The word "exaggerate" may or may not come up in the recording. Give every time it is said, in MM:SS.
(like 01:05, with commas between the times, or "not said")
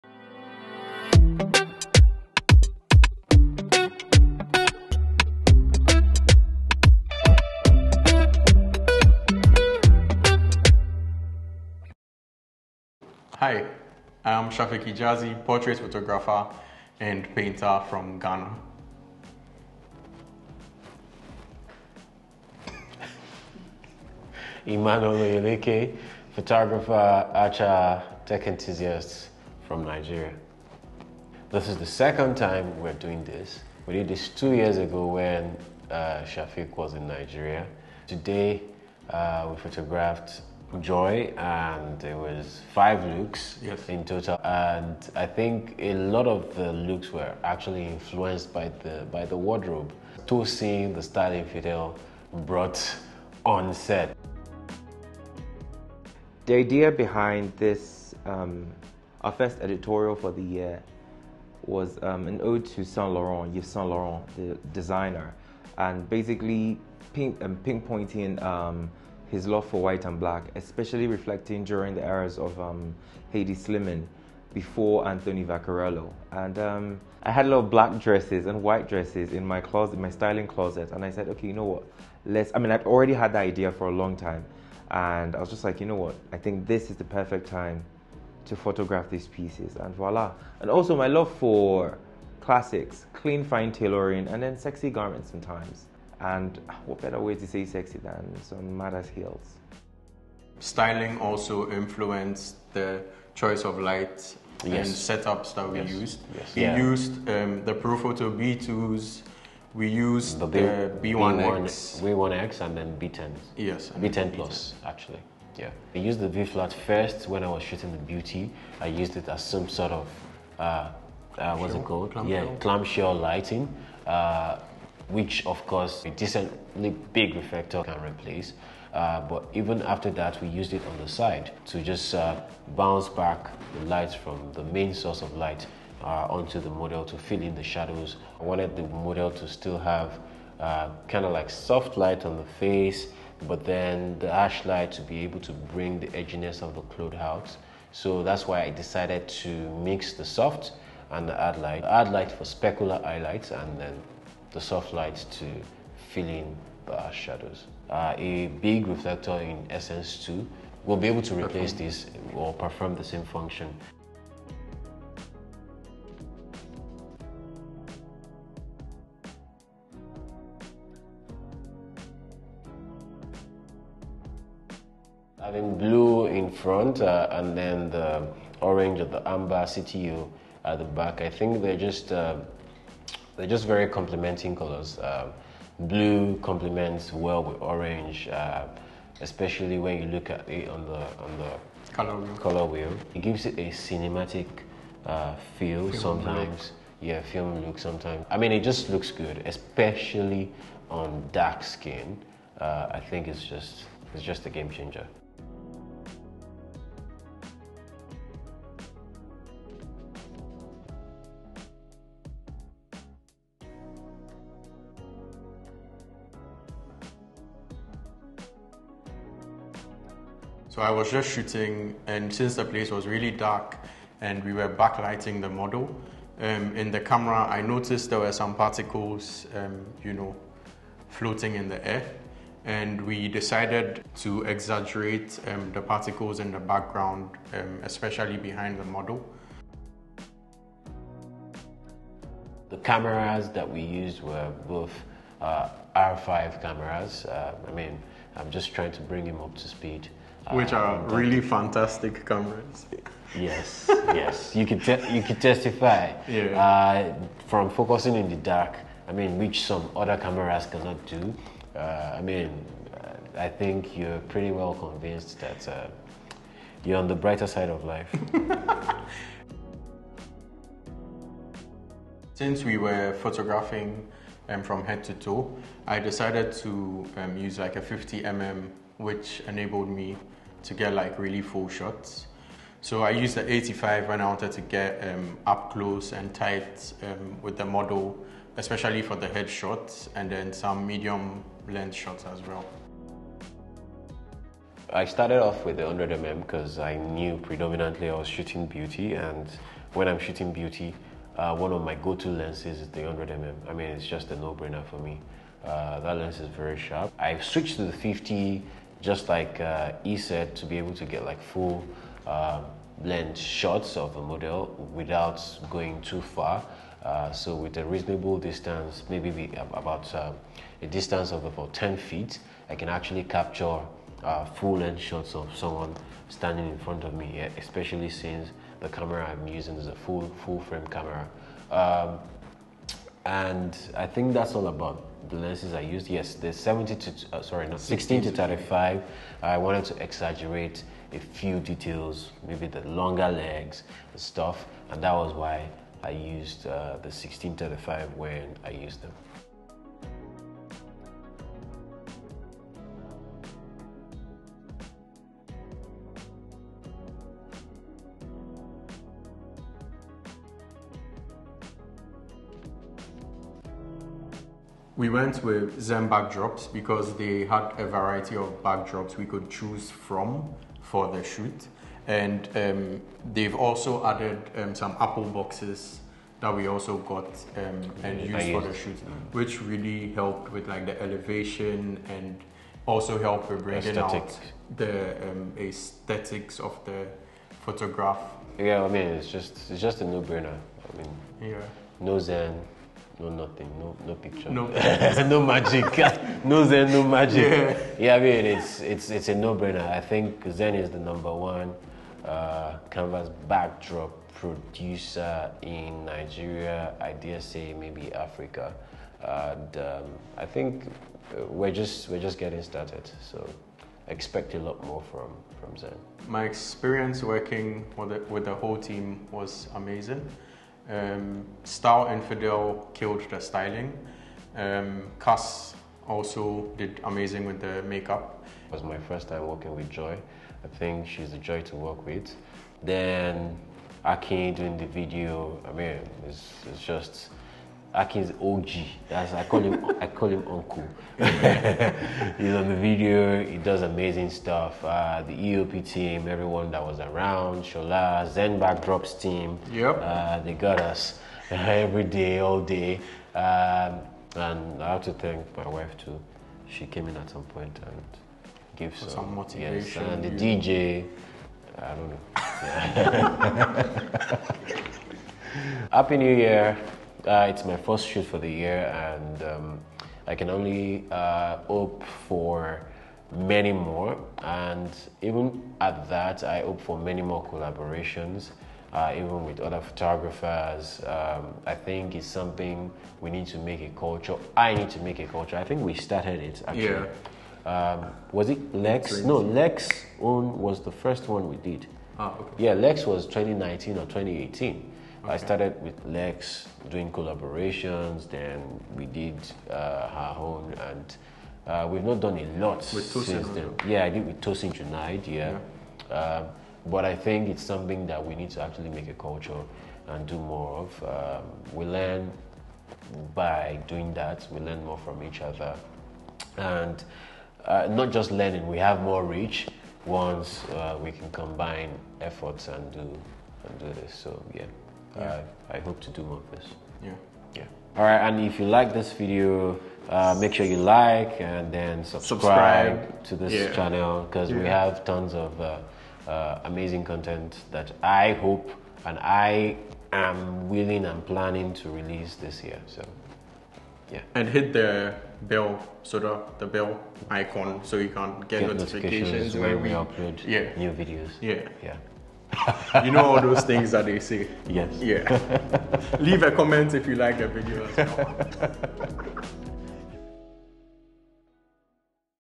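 03:54, 05:40.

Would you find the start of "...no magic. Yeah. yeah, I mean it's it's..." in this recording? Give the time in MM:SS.
06:36.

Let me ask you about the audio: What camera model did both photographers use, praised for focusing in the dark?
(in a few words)
R5.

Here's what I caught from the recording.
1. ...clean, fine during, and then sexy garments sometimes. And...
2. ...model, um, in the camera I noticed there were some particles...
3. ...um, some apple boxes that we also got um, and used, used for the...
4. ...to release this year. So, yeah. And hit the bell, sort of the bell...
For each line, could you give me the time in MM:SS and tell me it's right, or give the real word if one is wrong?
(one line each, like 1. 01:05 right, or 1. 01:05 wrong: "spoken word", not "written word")
1. 01:33 wrong: "tailoring", not "during"
2. 03:45 right
3. 06:14 right
4. 09:01 right.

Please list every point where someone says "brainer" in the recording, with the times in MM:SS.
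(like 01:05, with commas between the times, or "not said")
05:04, 06:30, 06:39.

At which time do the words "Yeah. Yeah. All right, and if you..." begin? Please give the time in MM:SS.
08:47.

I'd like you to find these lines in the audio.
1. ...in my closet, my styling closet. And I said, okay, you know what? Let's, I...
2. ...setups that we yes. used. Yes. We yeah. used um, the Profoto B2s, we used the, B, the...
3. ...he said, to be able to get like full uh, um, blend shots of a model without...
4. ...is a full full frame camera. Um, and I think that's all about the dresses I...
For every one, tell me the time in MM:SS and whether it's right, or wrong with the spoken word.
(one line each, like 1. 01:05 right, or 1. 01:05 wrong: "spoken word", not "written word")
1. 01:19 right
2. 01:45 right
3. 05:10 right
4. 05:29 wrong: "lenses", not "dresses".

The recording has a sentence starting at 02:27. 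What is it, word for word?
So that's why I decided to mix the soft and the hard light.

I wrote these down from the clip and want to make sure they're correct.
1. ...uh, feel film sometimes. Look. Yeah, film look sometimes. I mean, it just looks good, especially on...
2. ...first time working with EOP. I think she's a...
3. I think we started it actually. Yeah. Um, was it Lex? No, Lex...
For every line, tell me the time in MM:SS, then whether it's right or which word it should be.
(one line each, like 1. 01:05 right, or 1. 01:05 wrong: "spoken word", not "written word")
1. 03:15 right
2. 07:08 wrong: "Joy", not "EOP"
3. 08:05 right.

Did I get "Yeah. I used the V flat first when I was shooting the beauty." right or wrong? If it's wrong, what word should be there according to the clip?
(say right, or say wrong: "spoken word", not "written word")
right.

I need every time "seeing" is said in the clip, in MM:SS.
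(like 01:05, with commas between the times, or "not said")
00:50.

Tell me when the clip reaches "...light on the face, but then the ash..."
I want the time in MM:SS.
02:21.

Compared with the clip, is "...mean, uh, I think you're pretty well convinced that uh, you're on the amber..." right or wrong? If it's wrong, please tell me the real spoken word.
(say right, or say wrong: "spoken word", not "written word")
wrong: "brighter", not "amber".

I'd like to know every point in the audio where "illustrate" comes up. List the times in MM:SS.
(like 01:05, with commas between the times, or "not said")
not said.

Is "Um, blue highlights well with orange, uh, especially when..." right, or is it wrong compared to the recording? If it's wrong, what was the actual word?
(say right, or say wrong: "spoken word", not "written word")
wrong: "complements", not "highlights".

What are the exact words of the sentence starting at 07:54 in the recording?
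And even at that, I hope for many more collaborations, uh, even with other photographers.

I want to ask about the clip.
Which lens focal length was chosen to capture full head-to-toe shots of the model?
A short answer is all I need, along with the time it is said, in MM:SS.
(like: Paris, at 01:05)
50mm, at 04:37.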